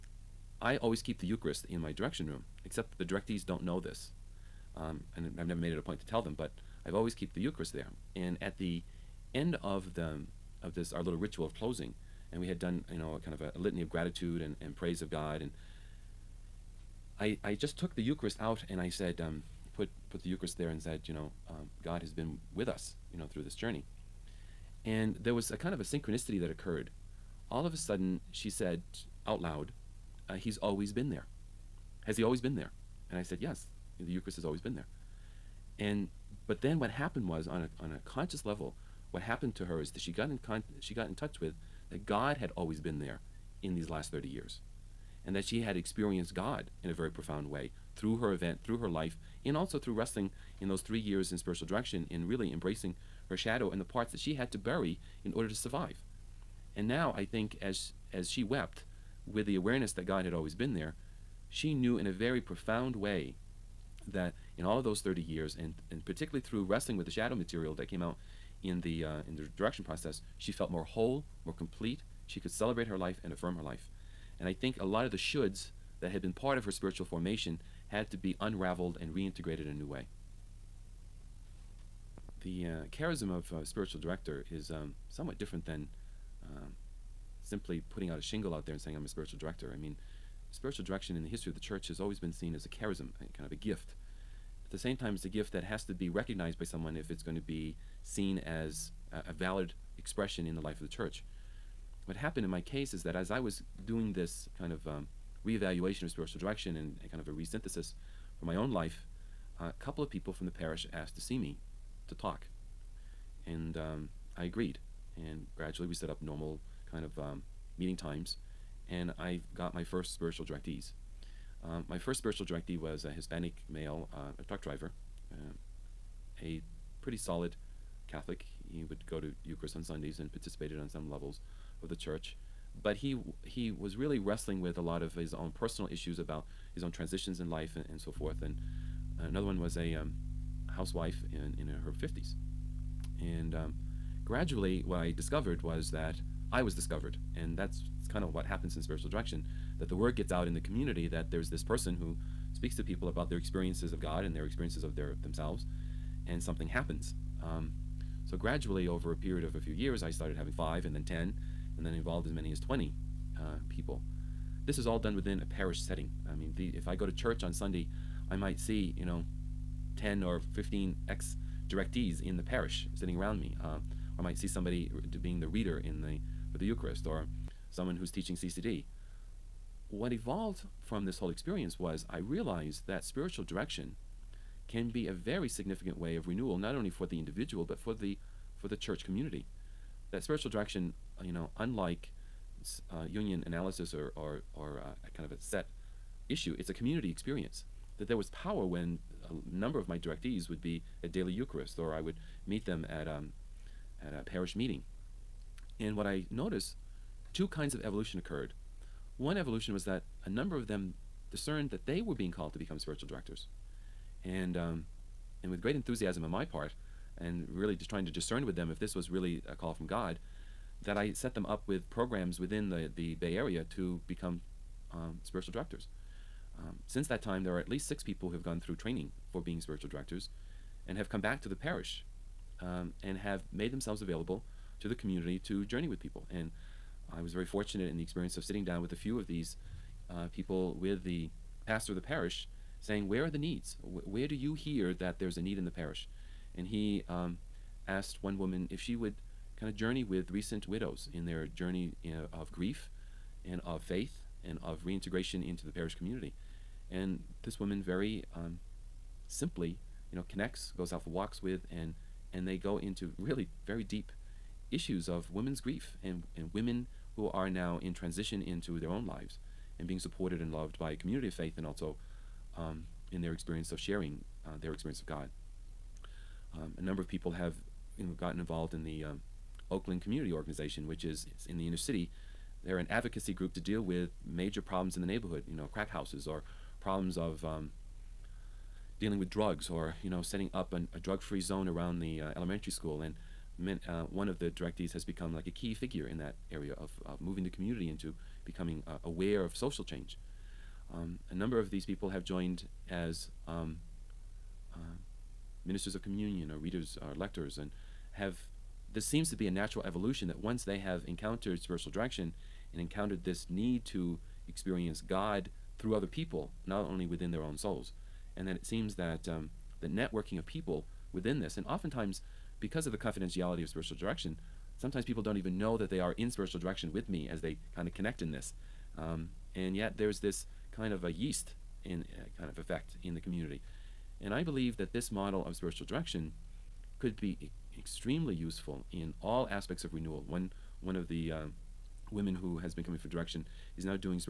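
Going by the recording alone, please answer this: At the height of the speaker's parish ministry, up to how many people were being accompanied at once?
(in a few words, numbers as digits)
20.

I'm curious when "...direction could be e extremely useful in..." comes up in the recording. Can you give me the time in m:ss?
5:35.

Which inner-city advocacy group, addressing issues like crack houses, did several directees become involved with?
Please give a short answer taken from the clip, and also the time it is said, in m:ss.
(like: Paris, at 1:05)
Oakland Community Organization, at 4:39.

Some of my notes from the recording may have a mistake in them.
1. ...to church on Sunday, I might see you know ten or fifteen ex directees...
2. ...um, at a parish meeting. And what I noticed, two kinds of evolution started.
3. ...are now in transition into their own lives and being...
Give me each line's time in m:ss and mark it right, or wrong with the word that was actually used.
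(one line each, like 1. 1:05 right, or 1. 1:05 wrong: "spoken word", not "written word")
1. 2:47 right
2. 3:23 wrong: "occurred", not "started"
3. 4:27 right.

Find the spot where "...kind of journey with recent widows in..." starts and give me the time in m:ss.
4:09.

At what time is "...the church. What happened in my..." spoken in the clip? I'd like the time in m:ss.
1:40.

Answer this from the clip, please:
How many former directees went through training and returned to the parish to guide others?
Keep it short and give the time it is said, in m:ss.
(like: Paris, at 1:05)
6, at 3:47.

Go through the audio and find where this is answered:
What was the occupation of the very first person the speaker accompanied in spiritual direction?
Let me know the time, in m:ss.
2:04.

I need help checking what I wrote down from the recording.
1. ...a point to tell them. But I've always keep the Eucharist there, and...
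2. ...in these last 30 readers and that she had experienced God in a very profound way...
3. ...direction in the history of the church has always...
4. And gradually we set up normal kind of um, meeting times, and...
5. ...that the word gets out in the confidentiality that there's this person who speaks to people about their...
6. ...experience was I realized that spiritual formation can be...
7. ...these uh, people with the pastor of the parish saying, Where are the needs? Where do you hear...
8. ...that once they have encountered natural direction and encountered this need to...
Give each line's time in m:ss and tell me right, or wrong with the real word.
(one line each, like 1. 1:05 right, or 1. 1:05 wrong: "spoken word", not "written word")
1. 0:05 right
2. 0:43 wrong: "years", not "readers"
3. 1:30 right
4. 1:55 right
5. 2:29 wrong: "community", not "confidentiality"
6. 3:01 wrong: "direction", not "formation"
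7. 3:59 right
8. 5:10 wrong: "spiritual", not "natural".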